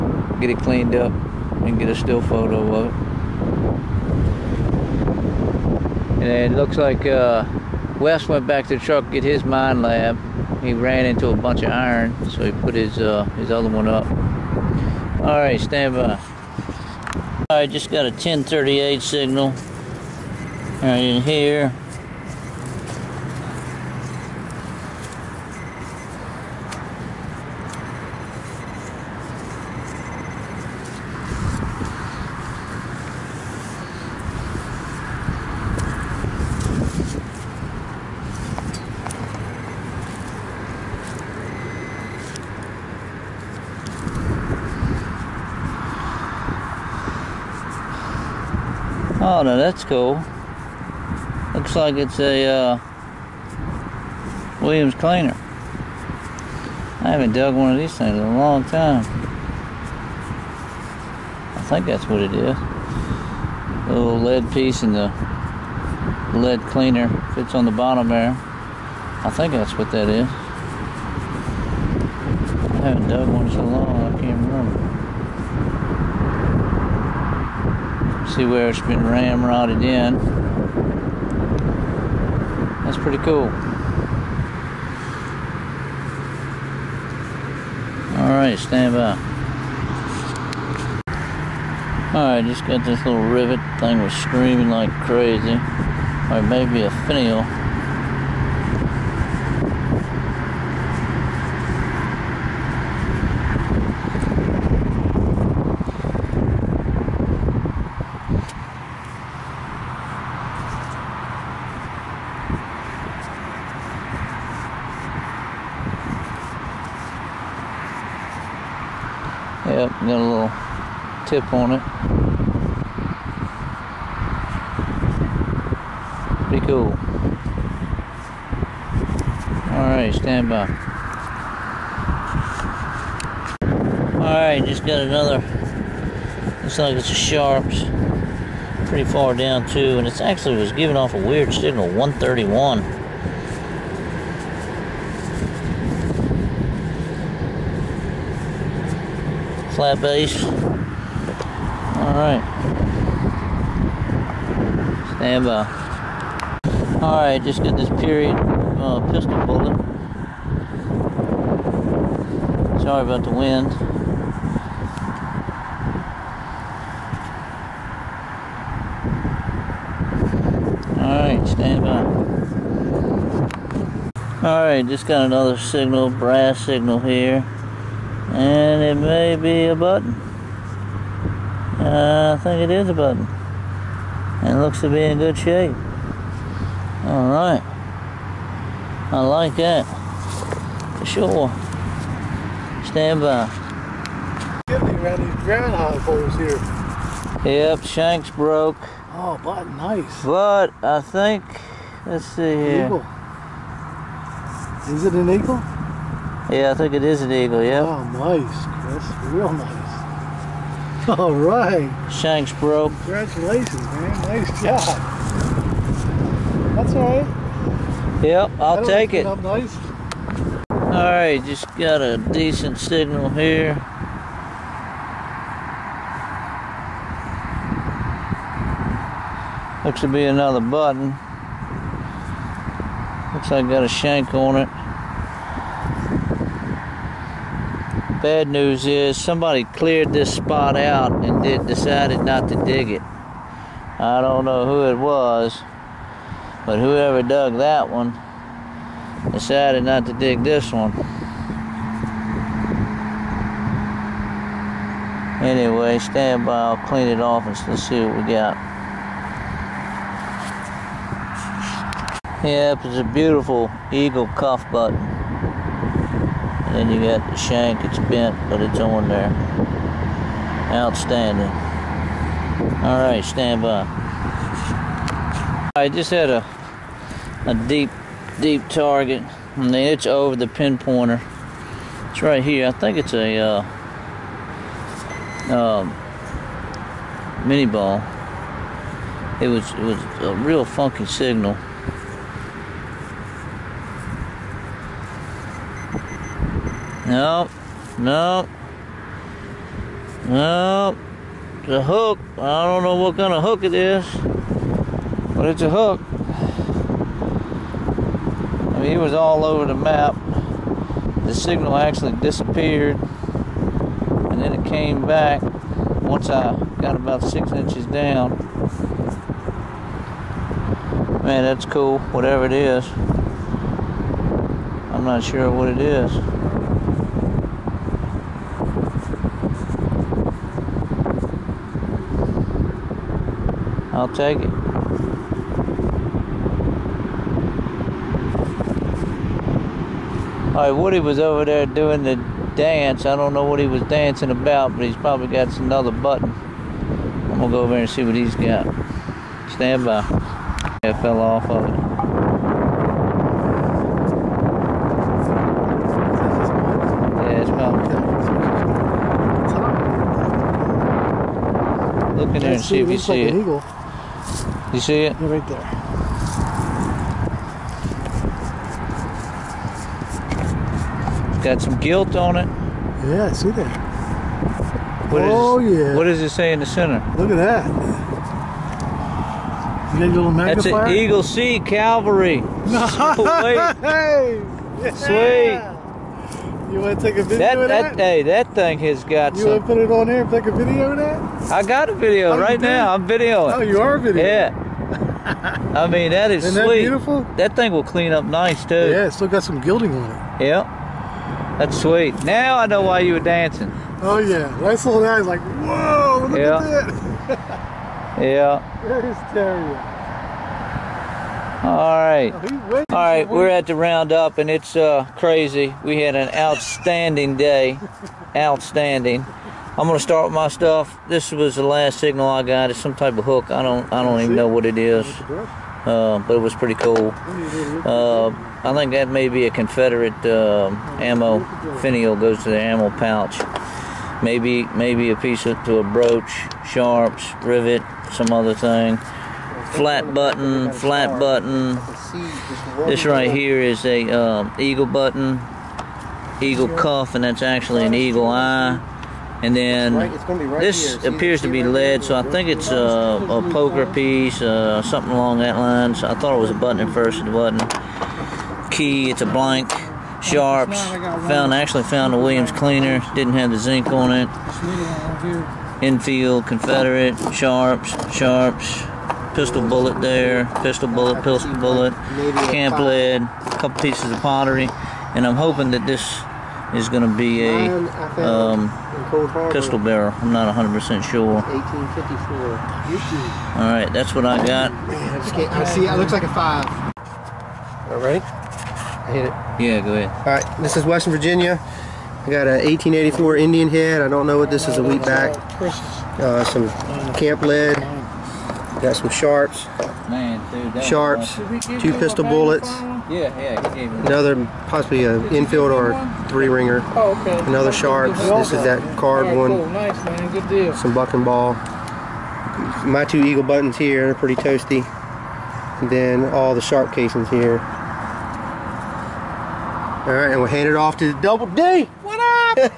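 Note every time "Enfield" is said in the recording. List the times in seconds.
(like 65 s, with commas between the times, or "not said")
465 s, 505 s.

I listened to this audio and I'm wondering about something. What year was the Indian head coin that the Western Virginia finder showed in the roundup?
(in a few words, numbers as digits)
1884.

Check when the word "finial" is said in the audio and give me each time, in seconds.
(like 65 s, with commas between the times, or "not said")
97 s, 431 s.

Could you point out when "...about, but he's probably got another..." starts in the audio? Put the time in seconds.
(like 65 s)
344 s.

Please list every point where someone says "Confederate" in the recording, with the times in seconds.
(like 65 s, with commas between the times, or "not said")
429 s, 466 s.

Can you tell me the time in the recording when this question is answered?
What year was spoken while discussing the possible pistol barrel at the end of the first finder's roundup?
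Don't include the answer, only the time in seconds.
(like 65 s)
481 s.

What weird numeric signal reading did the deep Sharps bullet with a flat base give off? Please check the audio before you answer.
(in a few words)
131.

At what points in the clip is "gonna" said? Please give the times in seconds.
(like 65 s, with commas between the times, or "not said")
347 s, 419 s.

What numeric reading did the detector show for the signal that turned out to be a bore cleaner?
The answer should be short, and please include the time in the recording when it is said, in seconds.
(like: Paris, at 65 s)
1038, at 18 s.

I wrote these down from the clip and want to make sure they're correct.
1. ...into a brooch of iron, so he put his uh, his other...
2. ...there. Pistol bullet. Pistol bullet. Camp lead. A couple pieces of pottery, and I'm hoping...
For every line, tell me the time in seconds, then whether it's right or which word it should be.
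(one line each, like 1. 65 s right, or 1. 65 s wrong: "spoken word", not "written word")
1. 11 s wrong: "bunch", not "brooch"
2. 470 s right.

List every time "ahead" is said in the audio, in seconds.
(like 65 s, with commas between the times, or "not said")
489 s.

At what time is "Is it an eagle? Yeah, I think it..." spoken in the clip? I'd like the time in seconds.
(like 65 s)
204 s.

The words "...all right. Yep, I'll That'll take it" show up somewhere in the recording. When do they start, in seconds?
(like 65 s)
216 s.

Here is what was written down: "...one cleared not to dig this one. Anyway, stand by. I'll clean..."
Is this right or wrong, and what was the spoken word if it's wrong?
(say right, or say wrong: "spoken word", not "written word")
wrong: "decided", not "cleared".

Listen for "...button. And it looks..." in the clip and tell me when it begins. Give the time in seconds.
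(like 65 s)
182 s.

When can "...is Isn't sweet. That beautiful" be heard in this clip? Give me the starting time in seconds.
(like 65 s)
396 s.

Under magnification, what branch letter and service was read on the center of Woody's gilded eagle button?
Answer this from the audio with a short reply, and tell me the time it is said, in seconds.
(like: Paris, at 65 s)
Eagle C Cavalry, at 380 s.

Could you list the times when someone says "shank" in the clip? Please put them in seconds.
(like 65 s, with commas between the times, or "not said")
197 s, 212 s, 233 s, 267 s.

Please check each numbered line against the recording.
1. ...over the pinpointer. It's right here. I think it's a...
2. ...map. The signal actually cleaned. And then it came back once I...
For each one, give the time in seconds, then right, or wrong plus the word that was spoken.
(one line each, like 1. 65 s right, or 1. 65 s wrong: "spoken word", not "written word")
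1. 280 s right
2. 309 s wrong: "disappeared", not "cleaned".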